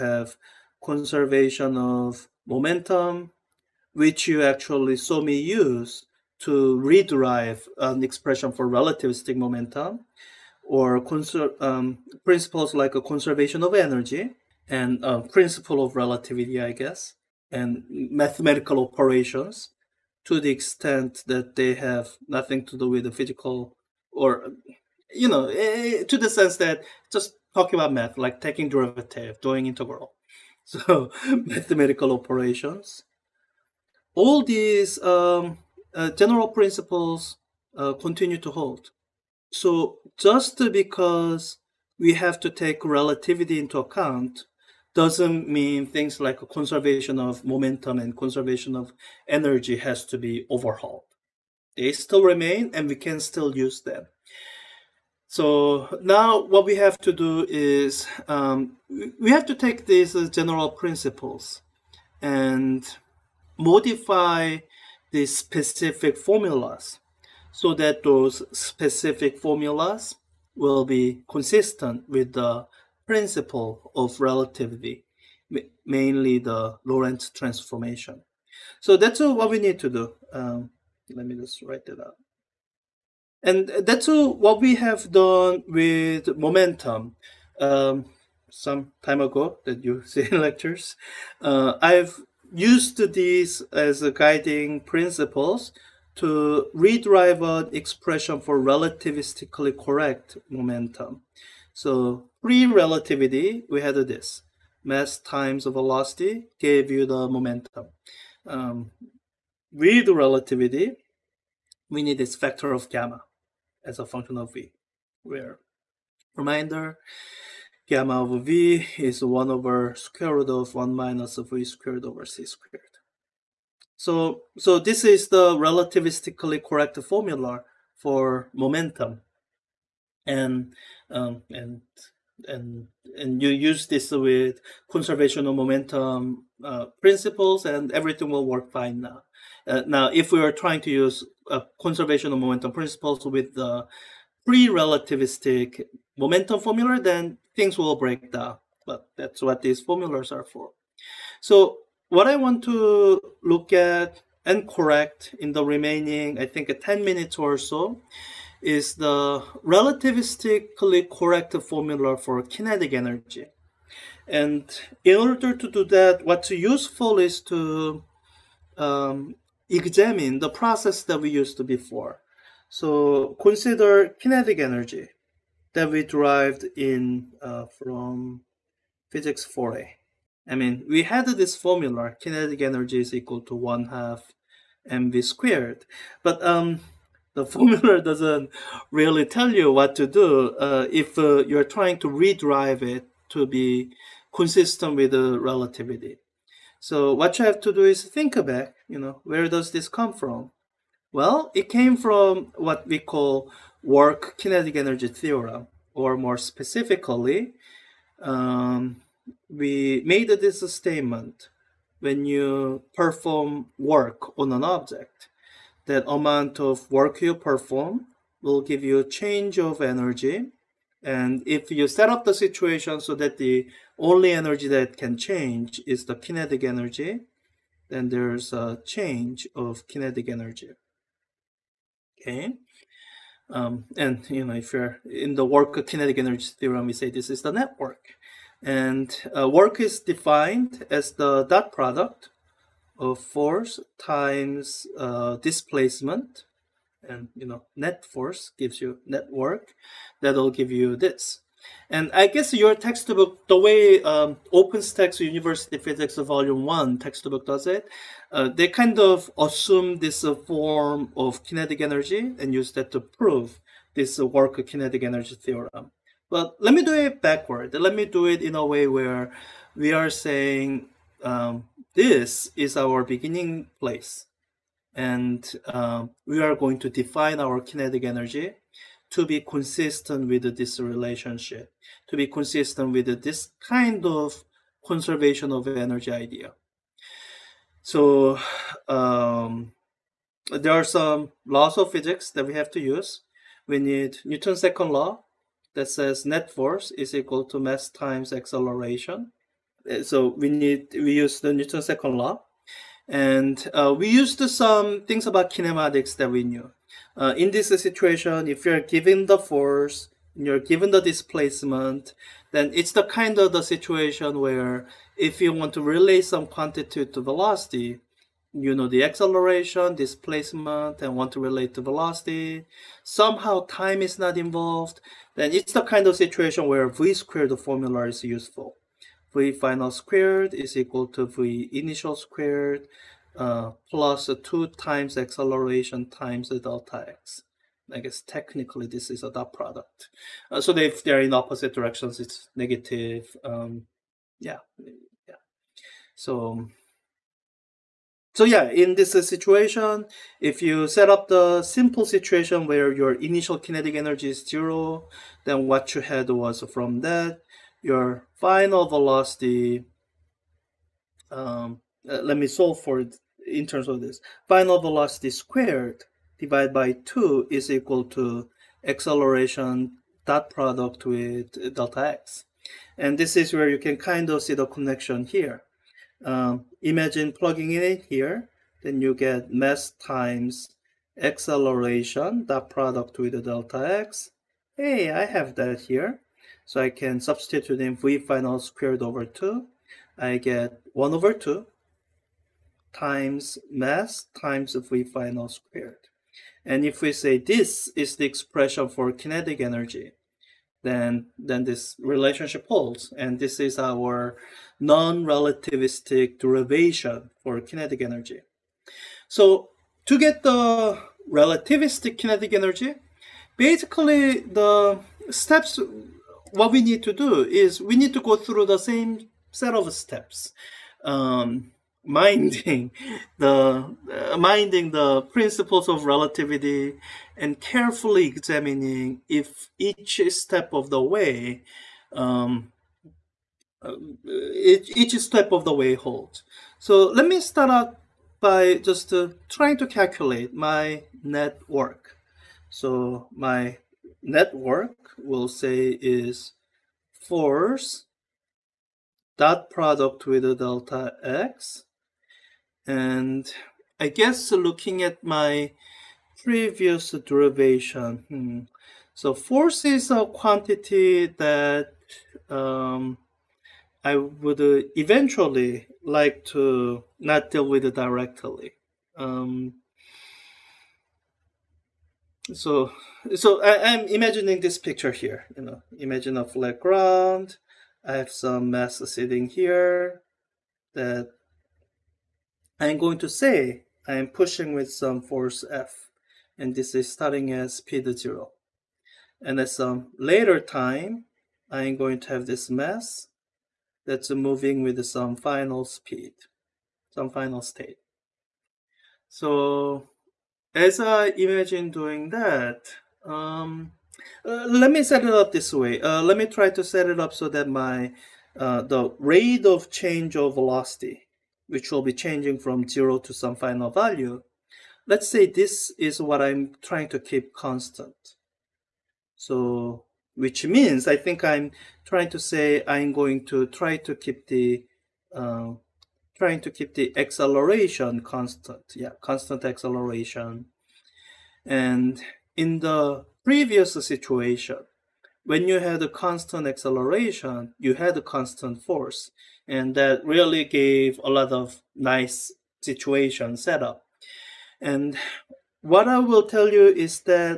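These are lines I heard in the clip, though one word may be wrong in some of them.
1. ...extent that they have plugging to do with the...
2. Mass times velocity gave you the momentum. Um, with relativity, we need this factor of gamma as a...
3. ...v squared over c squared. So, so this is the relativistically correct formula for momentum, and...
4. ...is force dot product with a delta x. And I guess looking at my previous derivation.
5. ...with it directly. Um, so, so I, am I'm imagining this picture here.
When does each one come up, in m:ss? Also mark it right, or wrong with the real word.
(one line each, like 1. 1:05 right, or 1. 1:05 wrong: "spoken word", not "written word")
1. 0:20 wrong: "nothing", not "plugging"
2. 1:44 right
3. 2:01 right
4. 7:26 right
5. 7:47 right.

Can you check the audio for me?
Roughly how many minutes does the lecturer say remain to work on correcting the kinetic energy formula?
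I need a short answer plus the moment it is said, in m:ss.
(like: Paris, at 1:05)
10, at 2:36.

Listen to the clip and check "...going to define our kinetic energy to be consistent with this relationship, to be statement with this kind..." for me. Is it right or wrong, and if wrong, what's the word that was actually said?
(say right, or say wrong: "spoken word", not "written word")
wrong: "consistent", not "statement".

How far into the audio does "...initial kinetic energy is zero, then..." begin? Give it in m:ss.
5:53.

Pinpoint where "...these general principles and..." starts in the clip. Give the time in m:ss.
0:59.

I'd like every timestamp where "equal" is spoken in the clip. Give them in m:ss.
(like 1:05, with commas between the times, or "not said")
3:03, 4:57, 5:30, 6:07.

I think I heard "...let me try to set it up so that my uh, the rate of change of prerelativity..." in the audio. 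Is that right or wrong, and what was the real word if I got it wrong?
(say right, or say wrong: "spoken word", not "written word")
wrong: "velocity", not "prerelativity".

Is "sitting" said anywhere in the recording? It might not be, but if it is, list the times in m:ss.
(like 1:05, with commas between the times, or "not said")
7:59.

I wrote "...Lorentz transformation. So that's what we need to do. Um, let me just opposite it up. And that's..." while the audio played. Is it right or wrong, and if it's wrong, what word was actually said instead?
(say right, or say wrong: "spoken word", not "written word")
wrong: "write", not "opposite".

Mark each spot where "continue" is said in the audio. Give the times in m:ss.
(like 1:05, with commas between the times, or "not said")
0:37.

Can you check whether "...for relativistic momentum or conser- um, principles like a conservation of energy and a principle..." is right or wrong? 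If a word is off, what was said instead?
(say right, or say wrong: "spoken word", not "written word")
right.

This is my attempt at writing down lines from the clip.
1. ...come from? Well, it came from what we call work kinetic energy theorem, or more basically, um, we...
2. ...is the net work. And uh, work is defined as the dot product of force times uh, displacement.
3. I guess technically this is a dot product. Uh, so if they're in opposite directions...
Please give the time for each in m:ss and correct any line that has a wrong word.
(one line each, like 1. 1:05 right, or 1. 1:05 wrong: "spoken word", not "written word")
1. 3:19 wrong: "specifically", not "basically"
2. 3:57 right
3. 5:37 right.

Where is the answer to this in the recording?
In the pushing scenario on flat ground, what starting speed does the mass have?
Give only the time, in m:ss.
8:07.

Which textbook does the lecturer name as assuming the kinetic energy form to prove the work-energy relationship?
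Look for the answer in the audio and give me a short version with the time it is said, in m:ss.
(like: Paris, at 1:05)
OpenStax University Physics Volume 1, at 4:14.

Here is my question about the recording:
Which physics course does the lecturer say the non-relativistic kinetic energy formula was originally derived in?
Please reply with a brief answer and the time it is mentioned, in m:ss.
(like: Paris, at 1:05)
Physics 4a, at 2:59.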